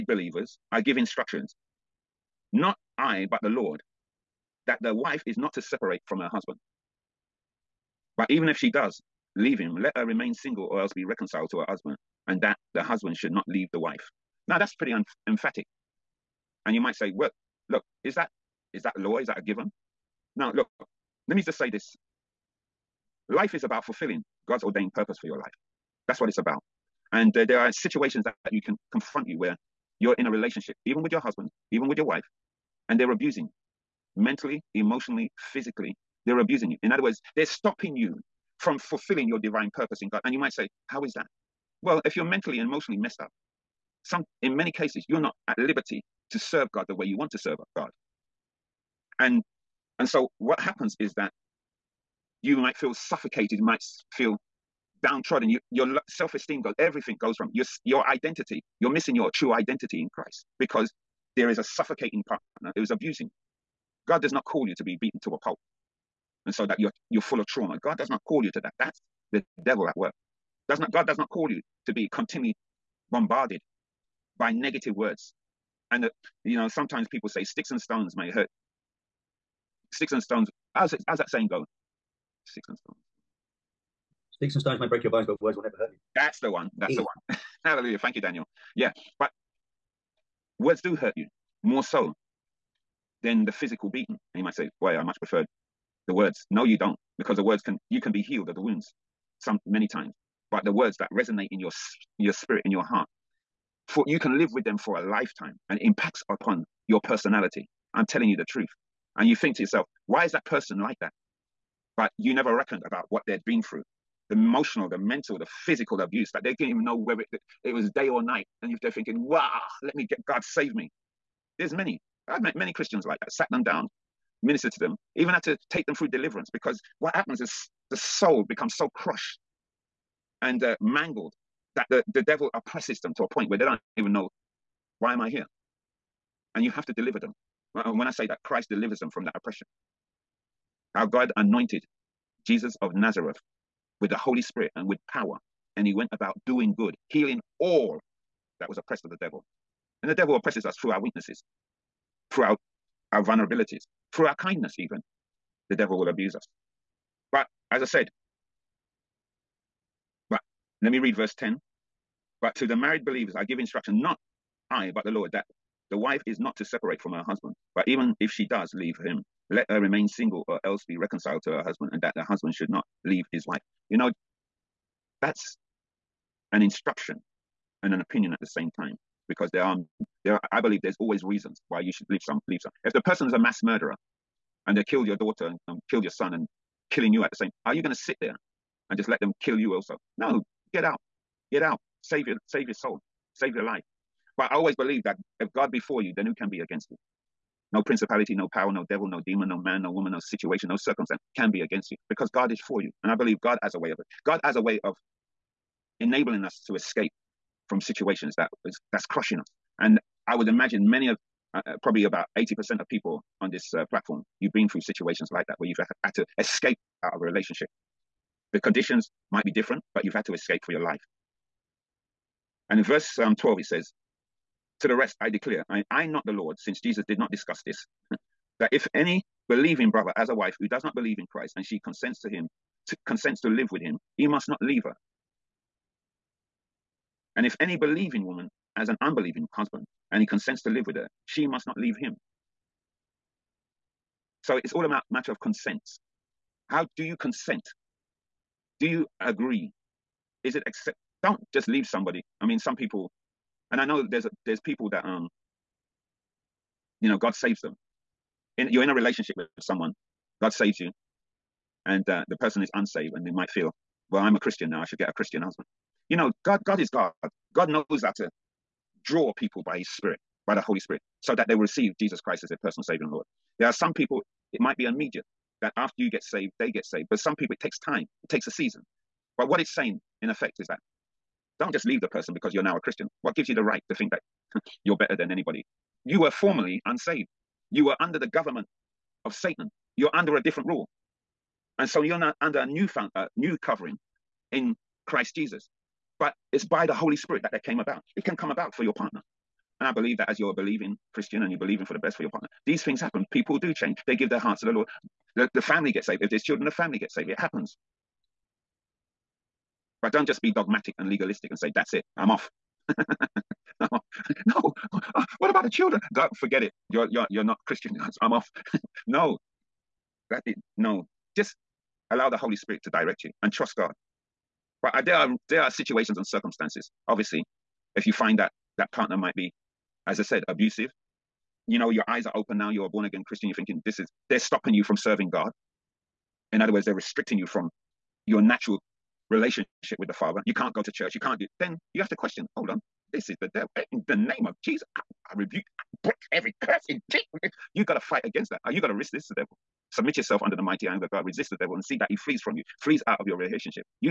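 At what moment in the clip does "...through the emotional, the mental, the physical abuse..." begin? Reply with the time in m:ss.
1:53.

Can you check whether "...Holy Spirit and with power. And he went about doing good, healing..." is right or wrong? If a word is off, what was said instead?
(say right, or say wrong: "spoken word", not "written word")
right.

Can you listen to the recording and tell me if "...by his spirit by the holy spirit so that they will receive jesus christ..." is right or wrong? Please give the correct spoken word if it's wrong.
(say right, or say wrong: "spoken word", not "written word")
right.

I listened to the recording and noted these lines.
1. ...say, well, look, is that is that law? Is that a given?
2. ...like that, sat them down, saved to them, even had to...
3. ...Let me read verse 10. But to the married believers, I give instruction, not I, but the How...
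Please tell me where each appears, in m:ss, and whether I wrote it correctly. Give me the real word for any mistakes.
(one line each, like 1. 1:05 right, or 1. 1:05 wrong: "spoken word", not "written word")
1. 0:16 right
2. 2:03 wrong: "ministered", not "saved"
3. 2:40 wrong: "Lord", not "How".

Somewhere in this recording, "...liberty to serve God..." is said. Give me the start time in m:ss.
0:45.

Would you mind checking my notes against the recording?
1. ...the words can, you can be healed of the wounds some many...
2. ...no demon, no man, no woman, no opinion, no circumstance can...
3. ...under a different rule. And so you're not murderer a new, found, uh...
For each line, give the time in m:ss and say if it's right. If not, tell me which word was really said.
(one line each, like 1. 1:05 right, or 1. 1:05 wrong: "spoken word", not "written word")
1. 1:37 right
2. 3:19 wrong: "situation", not "opinion"
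3. 4:50 wrong: "under", not "murderer".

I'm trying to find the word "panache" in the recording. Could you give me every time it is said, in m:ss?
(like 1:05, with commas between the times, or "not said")
not said.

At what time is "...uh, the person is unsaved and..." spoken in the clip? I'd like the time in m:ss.
4:22.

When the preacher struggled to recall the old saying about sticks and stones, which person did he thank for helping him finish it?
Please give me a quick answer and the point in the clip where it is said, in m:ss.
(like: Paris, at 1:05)
Daniel, at 1:28.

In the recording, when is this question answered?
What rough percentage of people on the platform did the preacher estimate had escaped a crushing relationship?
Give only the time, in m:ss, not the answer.
3:32.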